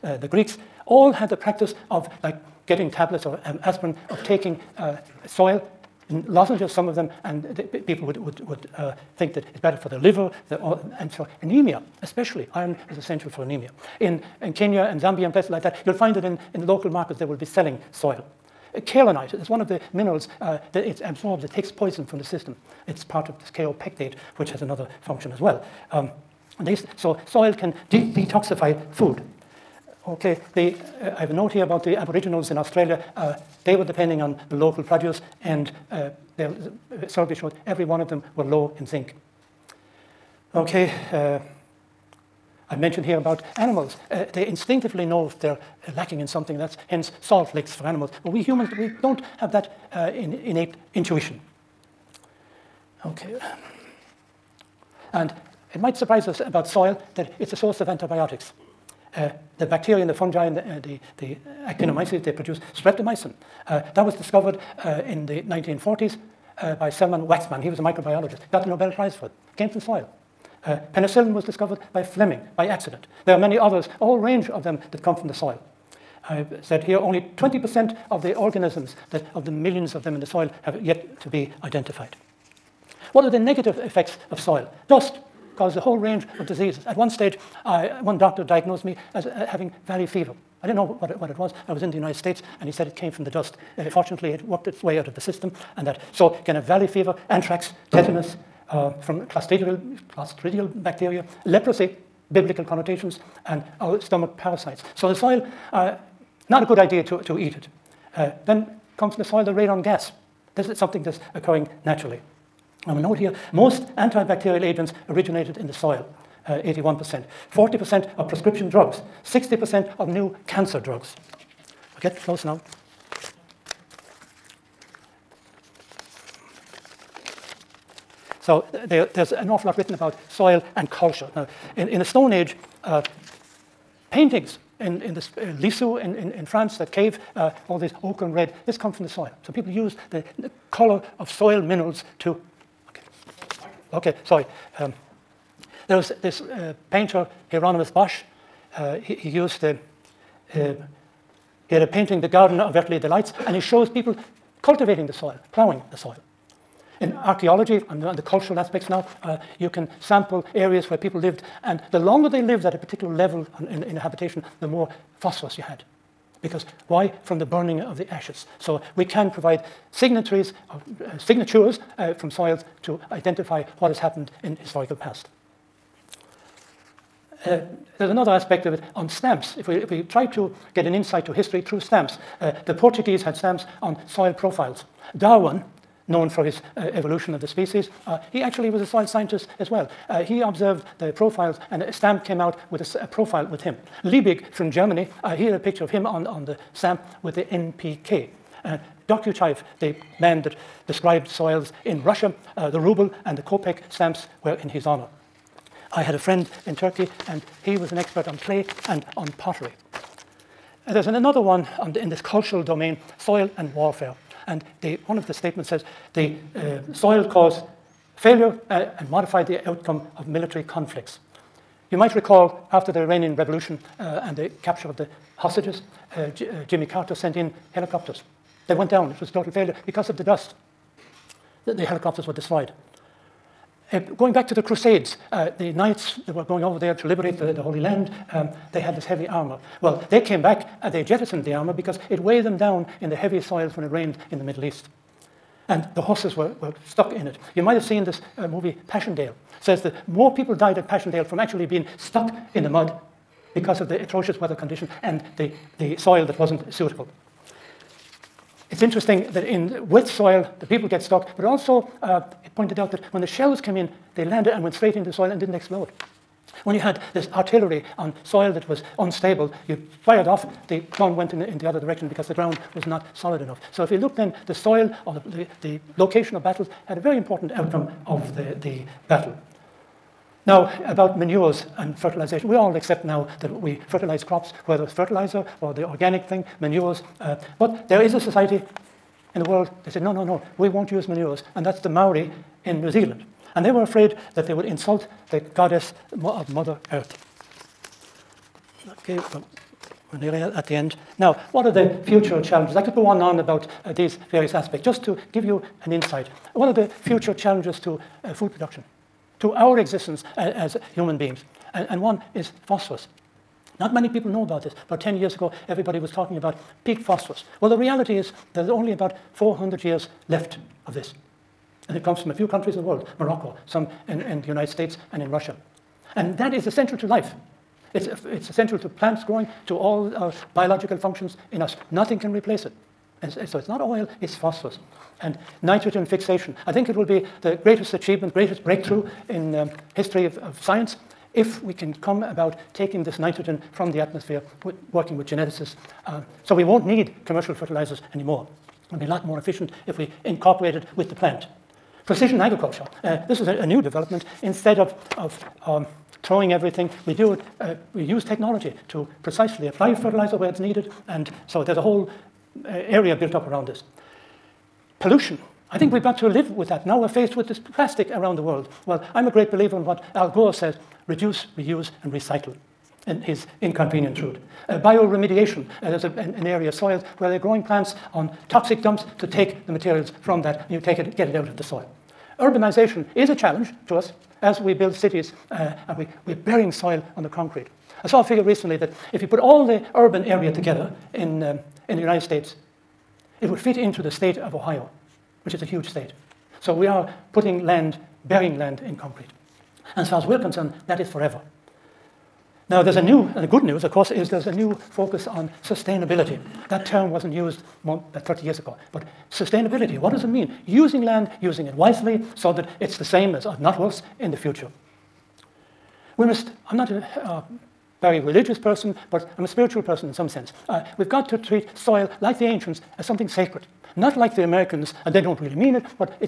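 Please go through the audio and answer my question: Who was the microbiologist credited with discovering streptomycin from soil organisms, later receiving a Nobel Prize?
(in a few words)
Selman Waxman.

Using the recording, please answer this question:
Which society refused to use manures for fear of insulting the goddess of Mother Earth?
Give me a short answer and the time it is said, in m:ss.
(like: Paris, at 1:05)
The Maori, at 4:51.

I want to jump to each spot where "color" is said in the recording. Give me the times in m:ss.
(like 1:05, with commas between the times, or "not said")
2:20.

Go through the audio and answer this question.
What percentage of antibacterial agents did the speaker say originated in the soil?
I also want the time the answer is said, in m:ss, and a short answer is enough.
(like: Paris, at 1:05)
81%, at 1:56.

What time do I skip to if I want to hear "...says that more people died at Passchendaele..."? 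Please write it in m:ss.
4:09.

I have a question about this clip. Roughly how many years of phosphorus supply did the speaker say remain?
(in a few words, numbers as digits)
400 years.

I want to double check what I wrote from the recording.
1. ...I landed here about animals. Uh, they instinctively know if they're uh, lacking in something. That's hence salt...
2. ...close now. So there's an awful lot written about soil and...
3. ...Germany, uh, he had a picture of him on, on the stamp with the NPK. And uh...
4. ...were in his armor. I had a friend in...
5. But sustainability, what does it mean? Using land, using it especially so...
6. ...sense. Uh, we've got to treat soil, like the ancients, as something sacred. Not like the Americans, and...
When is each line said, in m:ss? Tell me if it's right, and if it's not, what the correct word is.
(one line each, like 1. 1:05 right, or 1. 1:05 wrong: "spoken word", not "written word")
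1. 0:42 wrong: "mentioned", not "landed"
2. 2:02 right
3. 3:14 right
4. 3:24 wrong: "honor", not "armor"
5. 6:48 wrong: "wisely", not "especially"
6. 7:00 right.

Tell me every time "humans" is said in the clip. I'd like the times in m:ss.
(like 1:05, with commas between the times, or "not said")
0:48, 5:10.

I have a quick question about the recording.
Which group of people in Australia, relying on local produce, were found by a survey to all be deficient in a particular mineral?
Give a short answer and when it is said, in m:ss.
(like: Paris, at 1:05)
Aboriginals, at 0:31.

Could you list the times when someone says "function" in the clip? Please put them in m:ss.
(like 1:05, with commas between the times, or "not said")
0:24, 5:30.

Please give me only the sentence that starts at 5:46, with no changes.
Uh, so we won't need commercial fertilizers anymore.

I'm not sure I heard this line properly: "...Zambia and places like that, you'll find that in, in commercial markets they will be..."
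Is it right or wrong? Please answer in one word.
wrong.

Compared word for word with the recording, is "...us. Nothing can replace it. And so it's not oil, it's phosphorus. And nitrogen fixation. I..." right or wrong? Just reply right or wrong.
right.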